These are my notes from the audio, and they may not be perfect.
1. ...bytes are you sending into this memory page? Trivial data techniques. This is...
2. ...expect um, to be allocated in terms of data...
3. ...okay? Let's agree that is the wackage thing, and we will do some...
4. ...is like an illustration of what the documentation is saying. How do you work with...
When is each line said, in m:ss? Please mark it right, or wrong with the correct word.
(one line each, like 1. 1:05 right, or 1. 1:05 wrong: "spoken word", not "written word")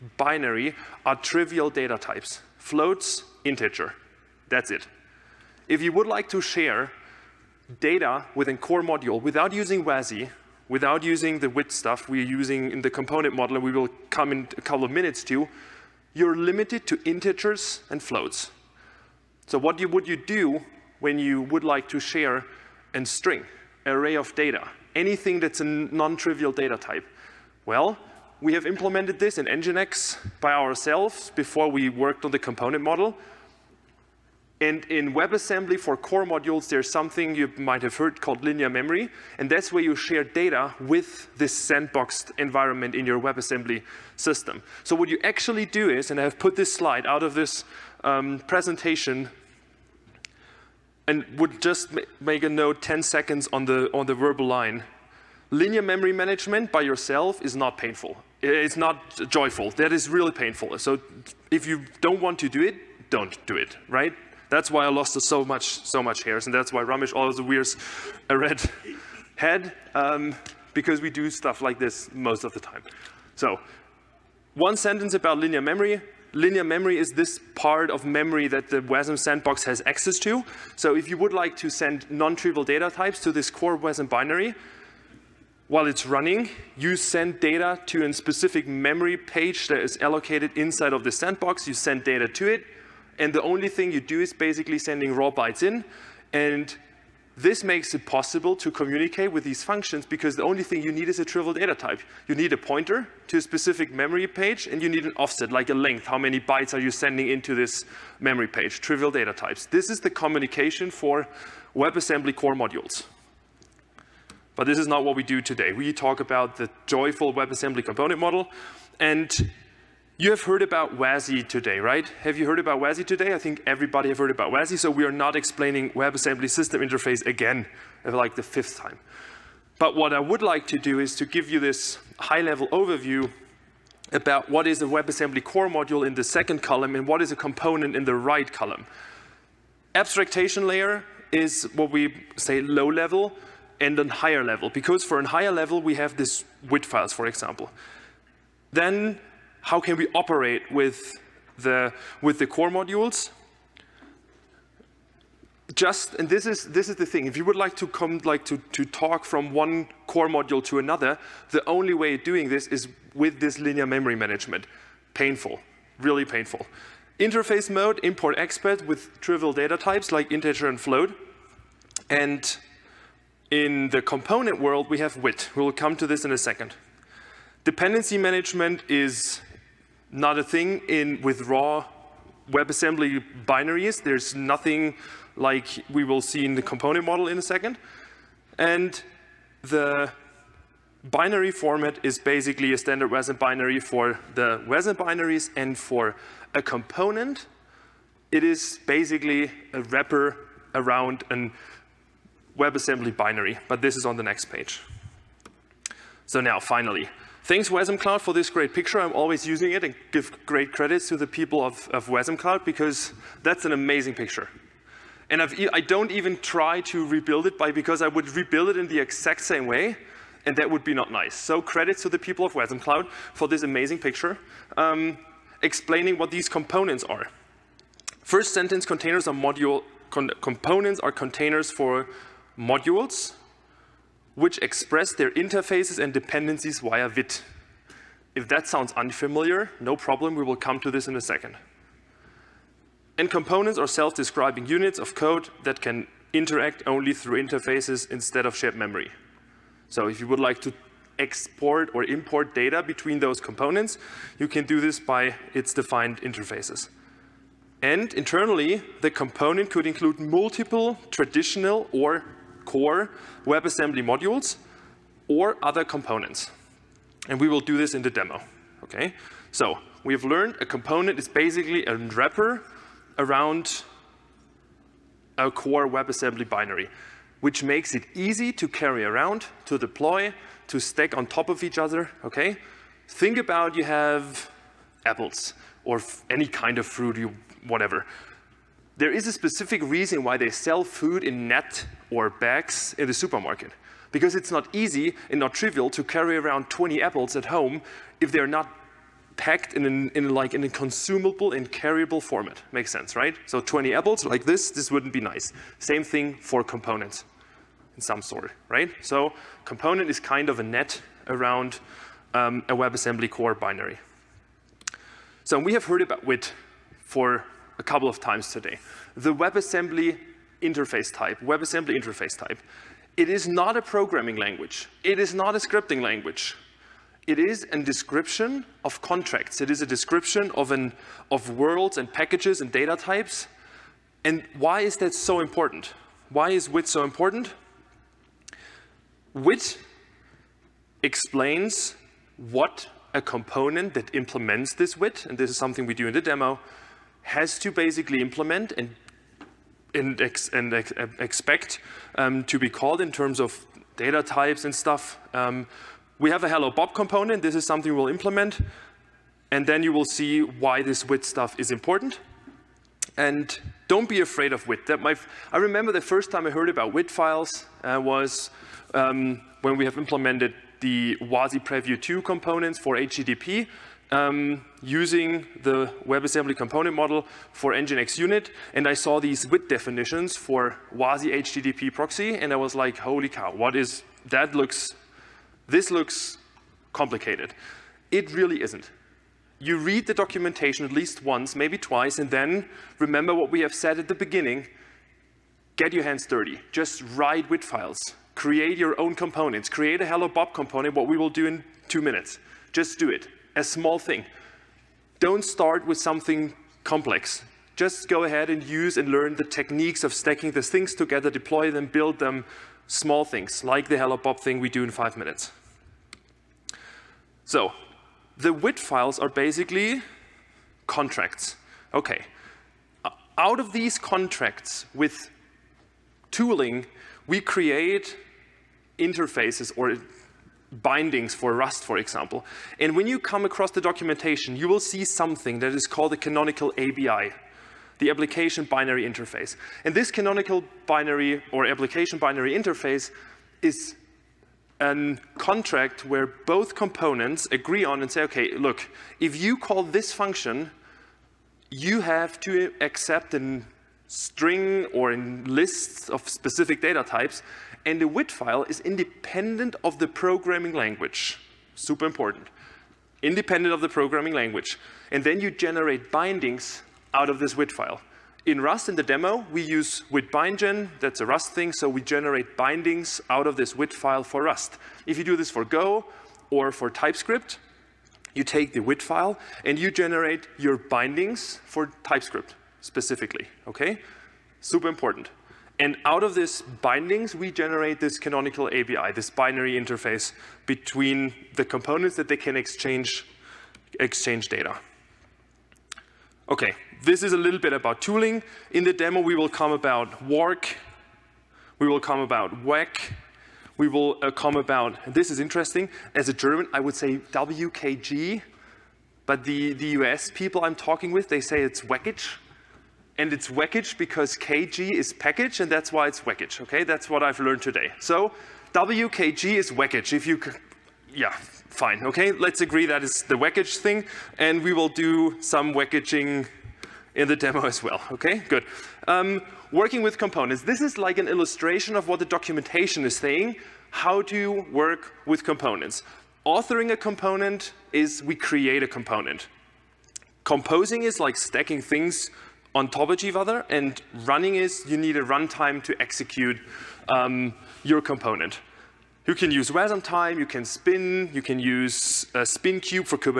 1. 1:46 wrong: "types", not "techniques"
2. 5:51 wrong: "called", not "allocated"
3. 8:42 right
4. 8:50 right.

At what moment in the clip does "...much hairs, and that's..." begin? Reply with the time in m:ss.
1:06.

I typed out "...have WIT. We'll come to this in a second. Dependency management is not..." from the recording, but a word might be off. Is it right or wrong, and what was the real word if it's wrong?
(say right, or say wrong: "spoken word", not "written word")
right.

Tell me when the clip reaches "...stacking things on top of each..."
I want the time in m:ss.
9:01.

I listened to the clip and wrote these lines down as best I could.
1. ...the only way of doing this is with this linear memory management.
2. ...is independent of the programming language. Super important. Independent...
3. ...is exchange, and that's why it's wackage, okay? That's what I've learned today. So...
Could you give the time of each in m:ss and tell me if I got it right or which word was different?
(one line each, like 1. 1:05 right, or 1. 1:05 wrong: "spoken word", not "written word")
1. 2:41 right
2. 7:38 right
3. 8:34 wrong: "package", not "exchange".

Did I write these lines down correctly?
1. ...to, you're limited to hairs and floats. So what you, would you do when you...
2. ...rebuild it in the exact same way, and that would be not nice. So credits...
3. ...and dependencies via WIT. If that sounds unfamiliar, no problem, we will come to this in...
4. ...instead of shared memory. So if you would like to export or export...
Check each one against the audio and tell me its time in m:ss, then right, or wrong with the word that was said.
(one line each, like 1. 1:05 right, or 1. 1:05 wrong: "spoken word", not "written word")
1. 0:15 wrong: "integers", not "hairs"
2. 3:38 right
3. 3:56 right
4. 4:08 wrong: "import", not "export".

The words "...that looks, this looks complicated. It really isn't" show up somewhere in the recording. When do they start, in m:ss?
6:24.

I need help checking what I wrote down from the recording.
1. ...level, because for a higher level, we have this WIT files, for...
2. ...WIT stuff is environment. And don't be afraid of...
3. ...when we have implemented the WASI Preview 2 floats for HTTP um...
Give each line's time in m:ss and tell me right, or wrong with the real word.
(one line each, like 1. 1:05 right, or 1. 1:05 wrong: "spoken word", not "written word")
1. 2:24 right
2. 6:01 wrong: "important", not "environment"
3. 6:09 wrong: "components", not "floats".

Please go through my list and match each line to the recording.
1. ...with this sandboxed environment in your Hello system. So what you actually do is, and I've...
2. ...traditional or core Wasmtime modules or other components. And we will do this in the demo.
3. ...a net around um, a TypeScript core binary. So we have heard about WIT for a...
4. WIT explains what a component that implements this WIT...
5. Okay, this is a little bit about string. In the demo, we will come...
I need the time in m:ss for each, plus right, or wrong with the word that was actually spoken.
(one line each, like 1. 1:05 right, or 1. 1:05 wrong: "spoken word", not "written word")
1. 0:40 wrong: "WebAssembly", not "Hello"
2. 4:21 wrong: "WebAssembly", not "Wasmtime"
3. 5:10 wrong: "WebAssembly", not "TypeScript"
4. 5:39 right
5. 8:16 wrong: "tooling", not "string".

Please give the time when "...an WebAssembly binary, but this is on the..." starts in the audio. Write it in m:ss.
3:21.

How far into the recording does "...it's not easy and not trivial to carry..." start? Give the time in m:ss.
4:54.